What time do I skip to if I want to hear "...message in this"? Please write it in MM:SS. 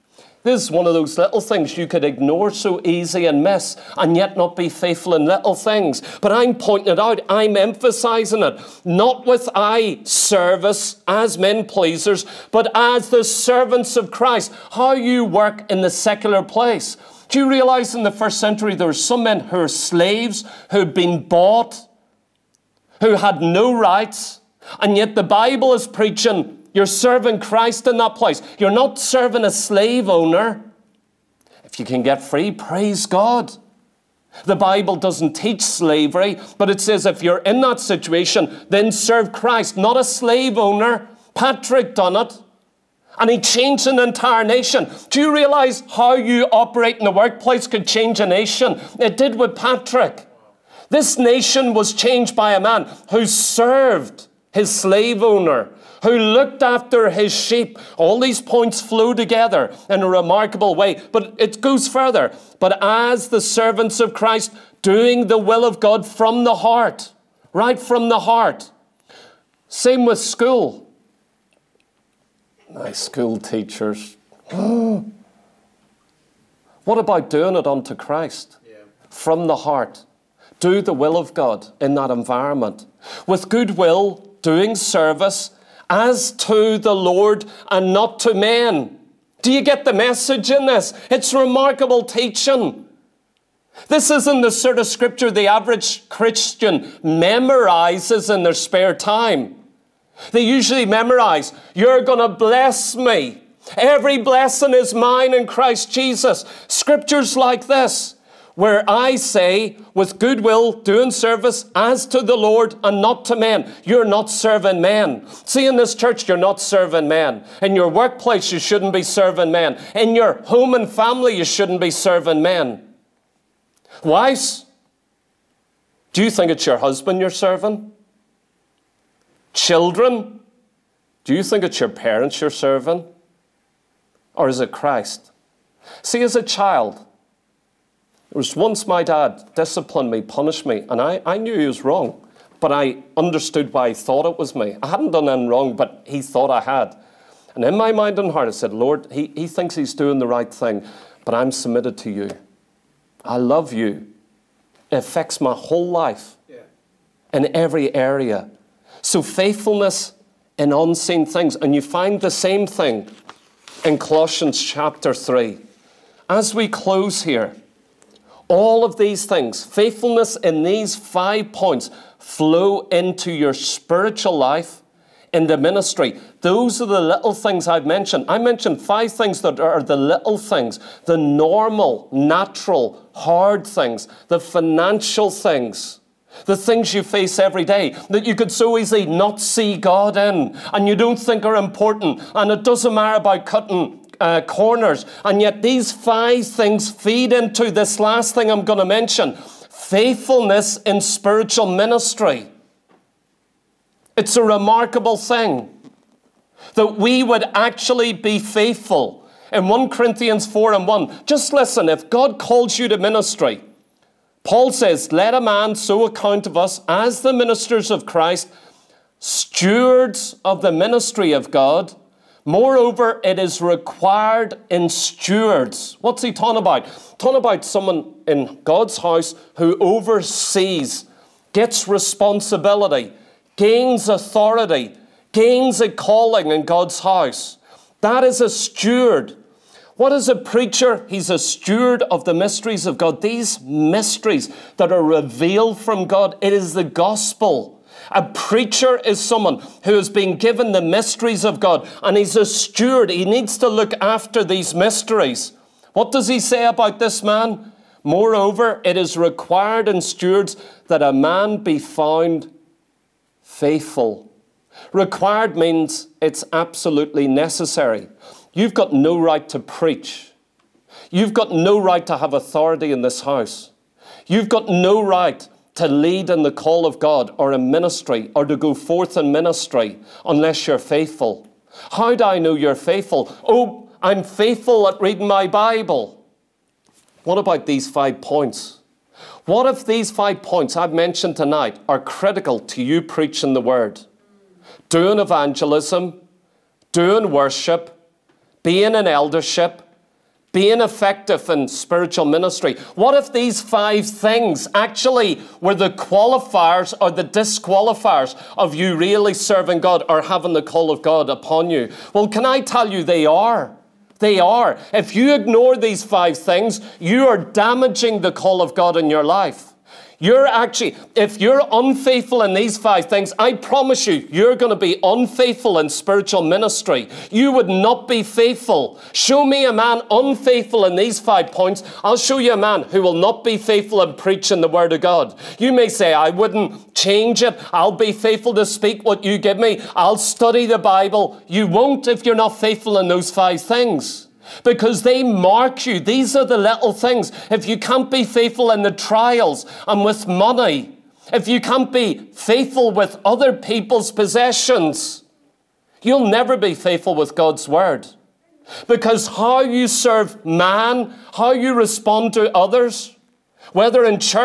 01:29.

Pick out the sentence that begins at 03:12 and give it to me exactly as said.
And it doesn't matter about cutting uh, corners.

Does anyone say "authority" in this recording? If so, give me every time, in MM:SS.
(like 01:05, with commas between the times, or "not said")
03:54, 04:32.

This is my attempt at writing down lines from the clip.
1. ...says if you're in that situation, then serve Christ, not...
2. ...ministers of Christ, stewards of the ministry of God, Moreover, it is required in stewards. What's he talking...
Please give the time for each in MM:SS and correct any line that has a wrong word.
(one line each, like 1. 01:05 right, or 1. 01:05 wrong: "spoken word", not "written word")
1. 00:36 right
2. 03:37 right.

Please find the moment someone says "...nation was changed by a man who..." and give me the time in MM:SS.
00:51.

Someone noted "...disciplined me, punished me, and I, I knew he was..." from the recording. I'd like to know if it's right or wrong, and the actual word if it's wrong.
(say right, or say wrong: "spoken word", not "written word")
right.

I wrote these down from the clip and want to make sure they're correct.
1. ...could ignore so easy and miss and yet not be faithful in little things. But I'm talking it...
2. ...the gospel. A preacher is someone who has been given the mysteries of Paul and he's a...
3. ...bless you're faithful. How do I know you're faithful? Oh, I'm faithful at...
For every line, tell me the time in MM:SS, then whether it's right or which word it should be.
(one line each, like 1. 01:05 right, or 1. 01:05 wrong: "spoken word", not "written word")
1. 00:01 wrong: "pointing", not "talking"
2. 04:06 wrong: "God", not "Paul"
3. 04:40 wrong: "unless", not "bless".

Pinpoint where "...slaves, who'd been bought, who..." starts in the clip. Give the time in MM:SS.
00:19.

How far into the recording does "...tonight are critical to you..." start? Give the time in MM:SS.
04:51.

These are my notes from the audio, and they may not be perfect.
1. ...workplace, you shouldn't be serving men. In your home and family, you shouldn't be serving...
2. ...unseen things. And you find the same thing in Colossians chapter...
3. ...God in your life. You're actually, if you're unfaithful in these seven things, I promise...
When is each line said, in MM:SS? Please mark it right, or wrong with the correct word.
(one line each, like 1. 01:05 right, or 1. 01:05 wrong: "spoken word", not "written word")
1. 01:57 right
2. 02:40 right
3. 05:18 wrong: "five", not "seven".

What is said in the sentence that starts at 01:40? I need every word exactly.
They usually memorize, You're going to bless me.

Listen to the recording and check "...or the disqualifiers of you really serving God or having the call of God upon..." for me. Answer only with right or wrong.
right.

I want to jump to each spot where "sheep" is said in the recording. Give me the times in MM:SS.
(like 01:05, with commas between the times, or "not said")
00:57.